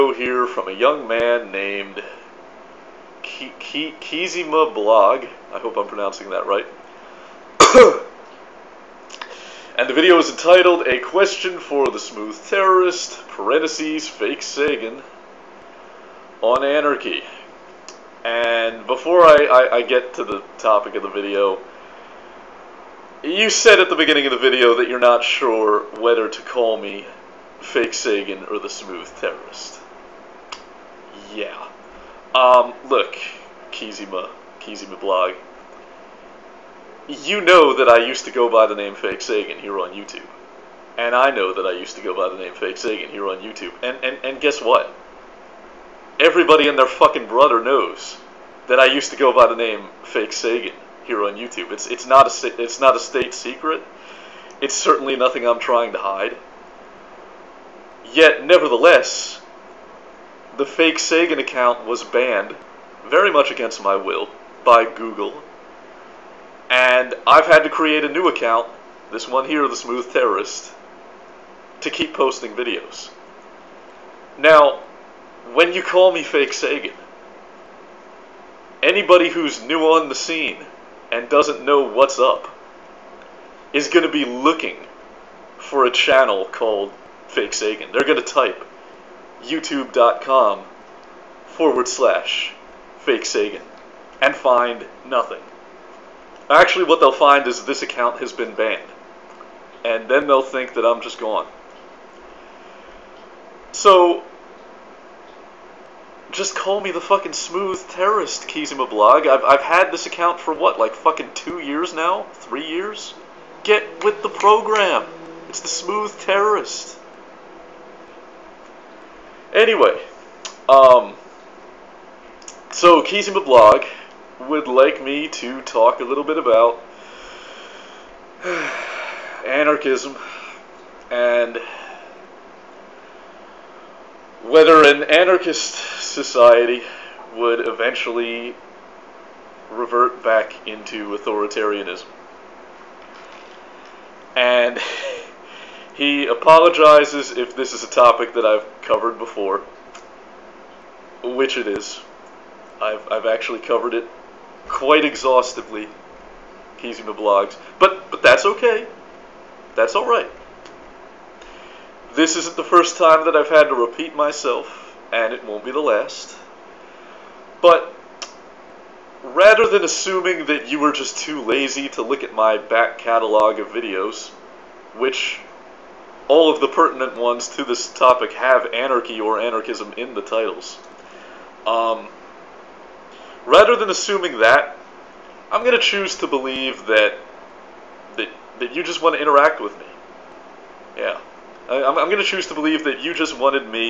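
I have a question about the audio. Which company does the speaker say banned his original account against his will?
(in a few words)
Google.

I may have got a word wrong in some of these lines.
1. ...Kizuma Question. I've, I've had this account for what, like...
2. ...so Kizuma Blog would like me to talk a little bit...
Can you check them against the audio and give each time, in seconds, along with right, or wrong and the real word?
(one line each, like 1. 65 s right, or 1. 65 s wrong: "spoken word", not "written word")
1. 108 s wrong: "Blog", not "Question"
2. 122 s right.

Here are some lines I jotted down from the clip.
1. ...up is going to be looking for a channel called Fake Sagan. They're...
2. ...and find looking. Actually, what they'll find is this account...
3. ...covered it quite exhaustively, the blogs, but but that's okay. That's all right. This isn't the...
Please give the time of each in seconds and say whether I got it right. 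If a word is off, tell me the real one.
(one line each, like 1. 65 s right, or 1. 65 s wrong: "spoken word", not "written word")
1. 82 s right
2. 94 s wrong: "nothing", not "looking"
3. 153 s right.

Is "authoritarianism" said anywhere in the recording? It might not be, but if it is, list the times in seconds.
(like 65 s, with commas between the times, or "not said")
141 s.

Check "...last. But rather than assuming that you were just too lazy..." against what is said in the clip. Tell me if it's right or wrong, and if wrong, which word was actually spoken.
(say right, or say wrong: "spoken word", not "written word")
right.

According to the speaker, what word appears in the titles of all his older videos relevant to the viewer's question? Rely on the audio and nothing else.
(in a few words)
anarchy or anarchism.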